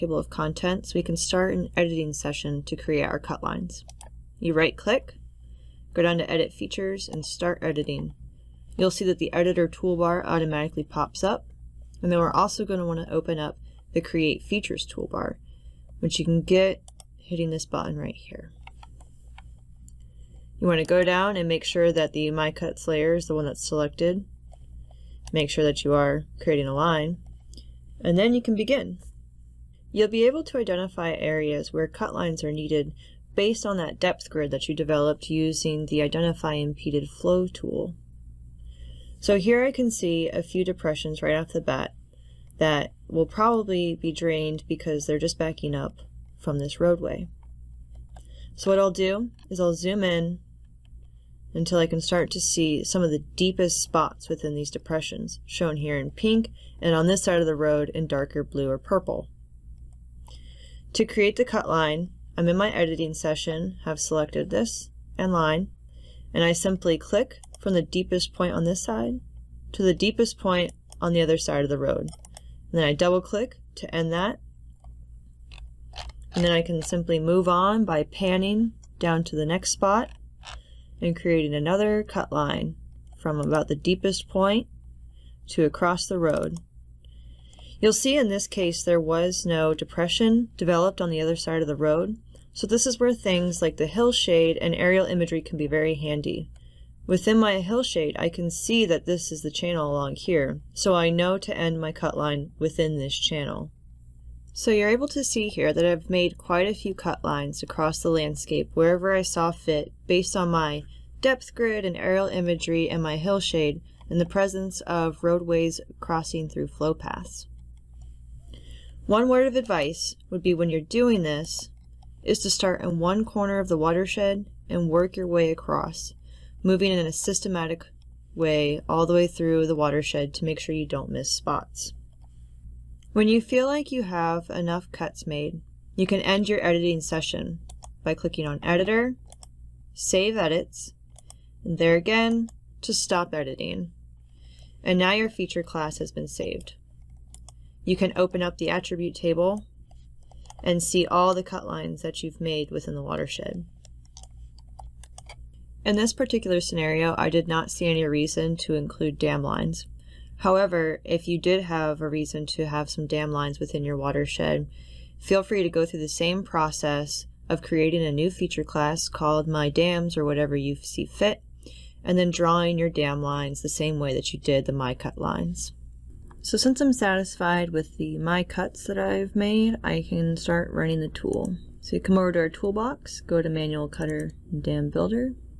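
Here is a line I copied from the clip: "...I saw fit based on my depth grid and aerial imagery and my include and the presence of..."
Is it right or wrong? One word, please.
wrong.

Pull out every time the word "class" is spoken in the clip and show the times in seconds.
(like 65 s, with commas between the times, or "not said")
145 s, 168 s.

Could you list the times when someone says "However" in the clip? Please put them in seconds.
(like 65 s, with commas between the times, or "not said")
160 s.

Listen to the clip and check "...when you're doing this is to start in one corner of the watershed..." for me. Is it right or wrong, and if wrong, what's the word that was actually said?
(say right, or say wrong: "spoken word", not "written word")
right.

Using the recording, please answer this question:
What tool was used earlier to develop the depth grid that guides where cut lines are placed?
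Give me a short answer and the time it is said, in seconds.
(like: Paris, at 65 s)
Identify Impeded Flow, at 36 s.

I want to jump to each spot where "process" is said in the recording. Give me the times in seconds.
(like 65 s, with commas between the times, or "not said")
166 s.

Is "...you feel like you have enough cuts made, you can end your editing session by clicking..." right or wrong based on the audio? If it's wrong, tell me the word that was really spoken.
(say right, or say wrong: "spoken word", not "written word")
right.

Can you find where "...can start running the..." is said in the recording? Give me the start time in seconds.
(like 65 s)
180 s.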